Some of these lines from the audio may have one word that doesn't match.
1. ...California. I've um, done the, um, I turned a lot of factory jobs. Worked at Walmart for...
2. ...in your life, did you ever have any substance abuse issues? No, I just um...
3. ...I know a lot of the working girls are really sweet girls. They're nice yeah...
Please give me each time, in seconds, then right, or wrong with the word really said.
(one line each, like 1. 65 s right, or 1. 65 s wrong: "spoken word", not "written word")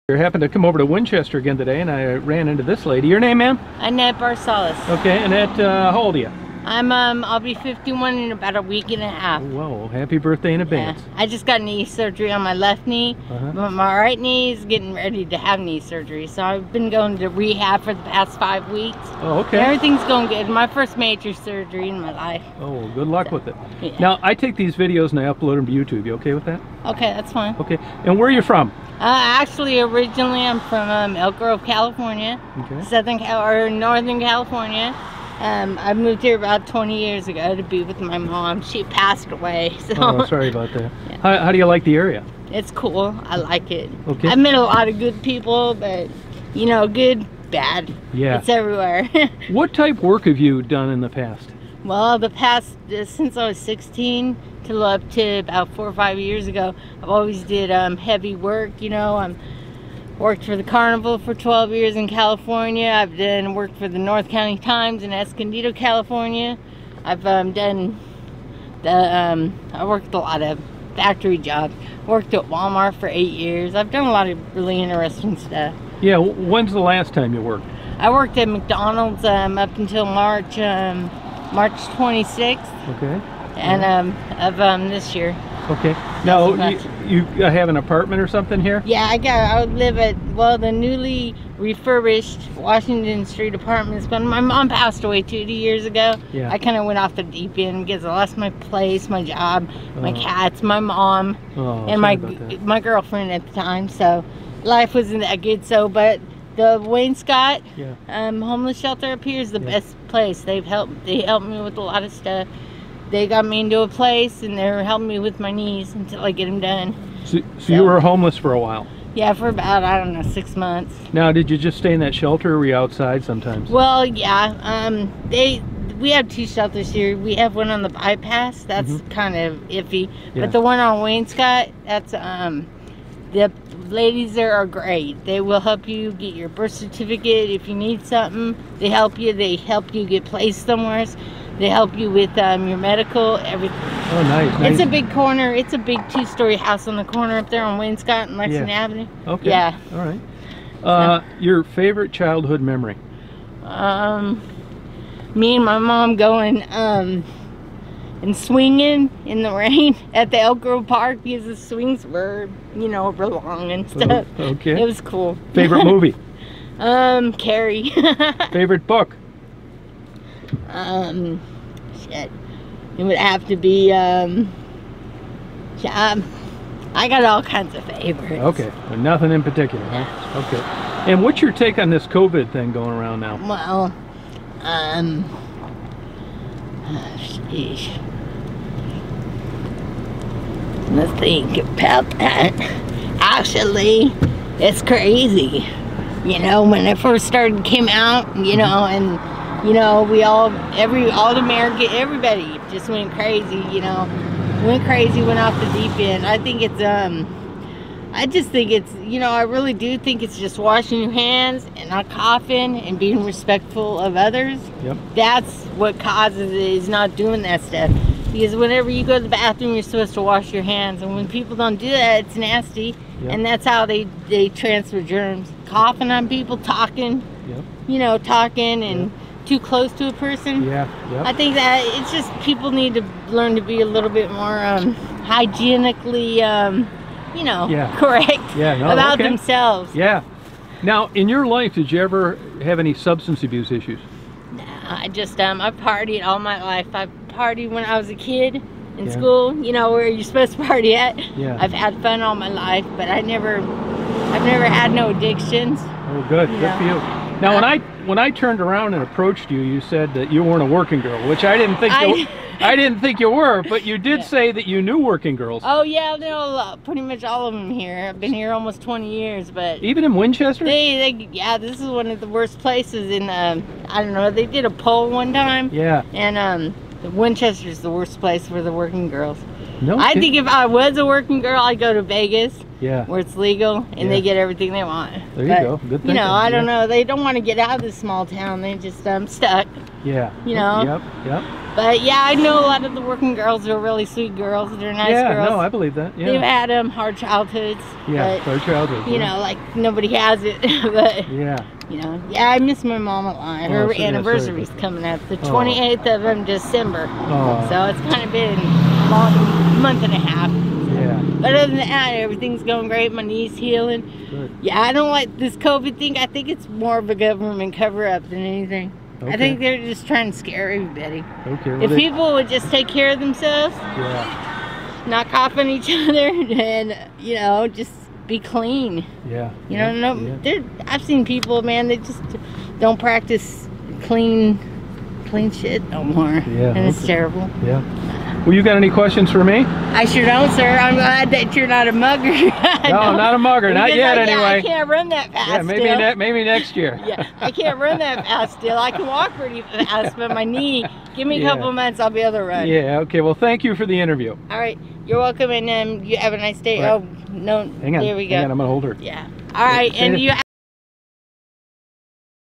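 1. 65 s wrong: "worked", not "turned"
2. 241 s right
3. 292 s right.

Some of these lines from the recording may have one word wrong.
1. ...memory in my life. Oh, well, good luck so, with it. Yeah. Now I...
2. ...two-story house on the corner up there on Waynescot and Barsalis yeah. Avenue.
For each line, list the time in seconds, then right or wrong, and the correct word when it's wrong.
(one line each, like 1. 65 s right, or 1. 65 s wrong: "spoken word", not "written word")
1. 21 s wrong: "surgery", not "memory"
2. 146 s wrong: "Lexington", not "Barsalis".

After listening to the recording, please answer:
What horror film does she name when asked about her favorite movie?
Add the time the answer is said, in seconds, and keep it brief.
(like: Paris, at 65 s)
Carrie, at 167 s.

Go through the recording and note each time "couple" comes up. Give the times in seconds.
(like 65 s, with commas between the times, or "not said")
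351 s.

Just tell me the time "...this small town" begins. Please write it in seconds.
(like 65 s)
287 s.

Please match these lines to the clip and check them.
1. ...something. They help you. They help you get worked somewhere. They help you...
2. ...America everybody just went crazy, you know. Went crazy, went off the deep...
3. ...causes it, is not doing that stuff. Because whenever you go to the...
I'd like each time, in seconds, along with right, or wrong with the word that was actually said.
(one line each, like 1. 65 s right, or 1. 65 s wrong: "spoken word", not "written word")
1. 138 s wrong: "placed", not "worked"
2. 201 s right
3. 216 s right.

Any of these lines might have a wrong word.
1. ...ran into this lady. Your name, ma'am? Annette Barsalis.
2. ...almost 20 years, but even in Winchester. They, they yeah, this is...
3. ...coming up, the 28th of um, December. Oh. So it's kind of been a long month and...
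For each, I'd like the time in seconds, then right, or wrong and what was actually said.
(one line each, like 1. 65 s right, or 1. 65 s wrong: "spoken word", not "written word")
1. 2 s right
2. 268 s right
3. 304 s right.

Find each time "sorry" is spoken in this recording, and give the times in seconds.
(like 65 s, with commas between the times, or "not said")
40 s.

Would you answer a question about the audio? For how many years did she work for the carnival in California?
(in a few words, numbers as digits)
12.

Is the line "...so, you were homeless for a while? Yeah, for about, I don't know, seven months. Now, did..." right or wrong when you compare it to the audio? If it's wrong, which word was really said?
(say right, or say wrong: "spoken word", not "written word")
wrong: "six", not "seven".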